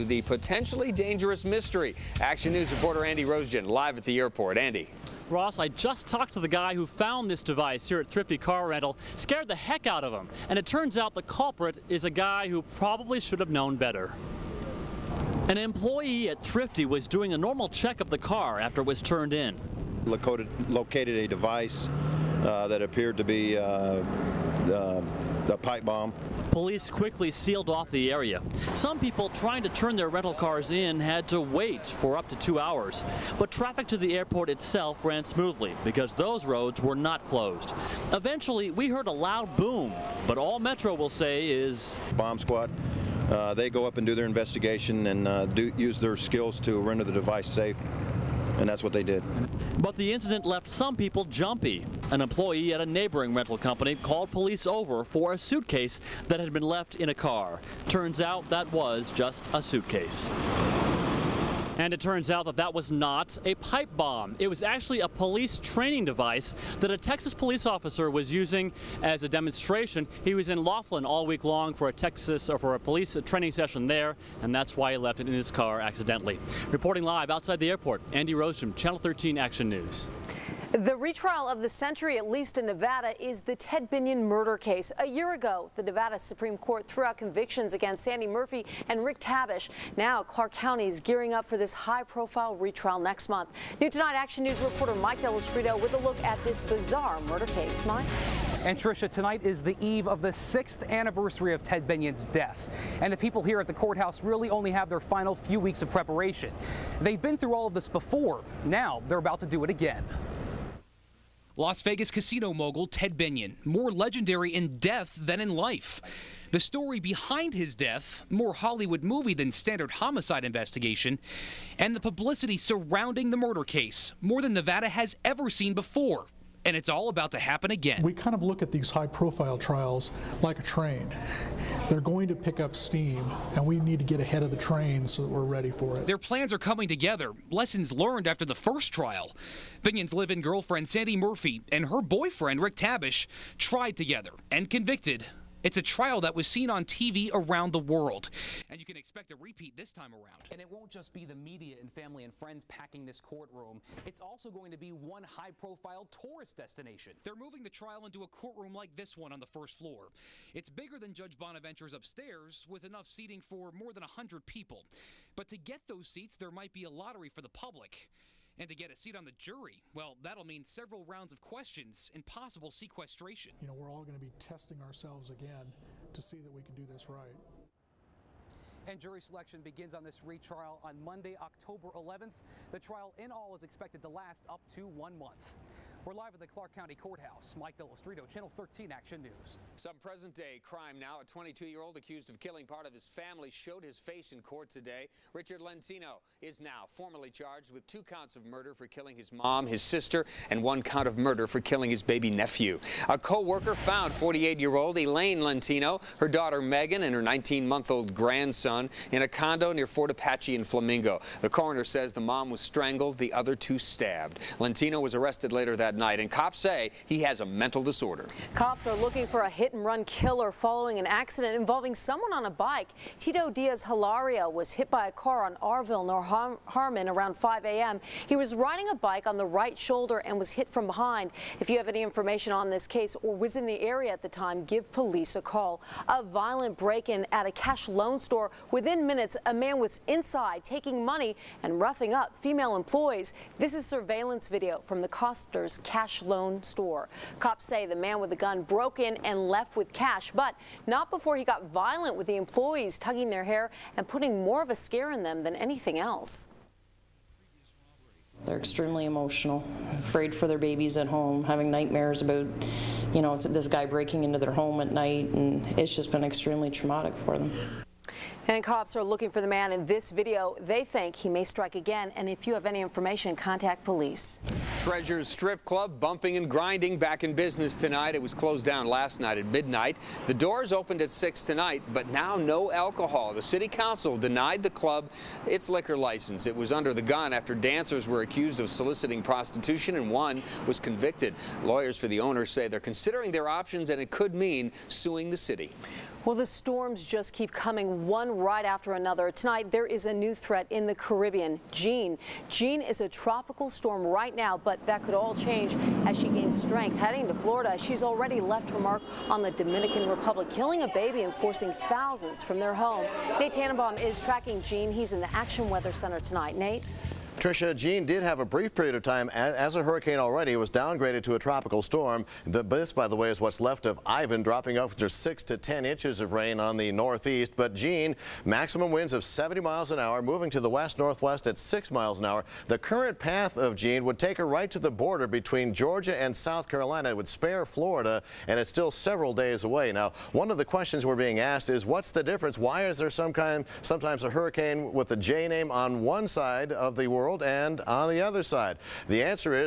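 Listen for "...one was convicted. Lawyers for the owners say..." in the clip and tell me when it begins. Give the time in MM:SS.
04:50.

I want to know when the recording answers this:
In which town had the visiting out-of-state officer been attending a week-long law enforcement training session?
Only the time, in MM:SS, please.
01:10.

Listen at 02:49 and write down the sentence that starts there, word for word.
Well, that'll mean several rounds of questions and possible sequestration.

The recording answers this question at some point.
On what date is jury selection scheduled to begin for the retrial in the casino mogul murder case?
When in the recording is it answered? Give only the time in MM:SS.
03:01.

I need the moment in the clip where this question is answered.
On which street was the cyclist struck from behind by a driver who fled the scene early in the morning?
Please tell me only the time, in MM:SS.
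03:45.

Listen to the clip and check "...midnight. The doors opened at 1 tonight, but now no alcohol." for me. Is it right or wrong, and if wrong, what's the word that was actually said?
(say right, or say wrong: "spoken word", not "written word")
wrong: "6", not "1".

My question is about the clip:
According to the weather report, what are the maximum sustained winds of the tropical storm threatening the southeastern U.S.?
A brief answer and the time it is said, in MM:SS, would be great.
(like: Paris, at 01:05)
70 miles an hour, at 05:29.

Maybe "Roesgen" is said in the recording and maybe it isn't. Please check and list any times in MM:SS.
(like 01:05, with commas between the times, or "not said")
00:03, 01:18.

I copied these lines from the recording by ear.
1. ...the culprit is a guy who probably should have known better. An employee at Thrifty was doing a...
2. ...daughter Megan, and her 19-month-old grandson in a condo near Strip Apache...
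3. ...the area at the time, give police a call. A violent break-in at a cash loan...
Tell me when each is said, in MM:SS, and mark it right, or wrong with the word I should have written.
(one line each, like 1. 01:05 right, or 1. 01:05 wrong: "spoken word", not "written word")
1. 00:11 right
2. 03:26 wrong: "Fort", not "Strip"
3. 03:53 right.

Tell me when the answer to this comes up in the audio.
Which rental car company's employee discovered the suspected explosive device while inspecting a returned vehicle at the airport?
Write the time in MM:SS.
00:08.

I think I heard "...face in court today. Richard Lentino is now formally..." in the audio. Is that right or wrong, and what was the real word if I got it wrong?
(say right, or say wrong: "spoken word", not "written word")
right.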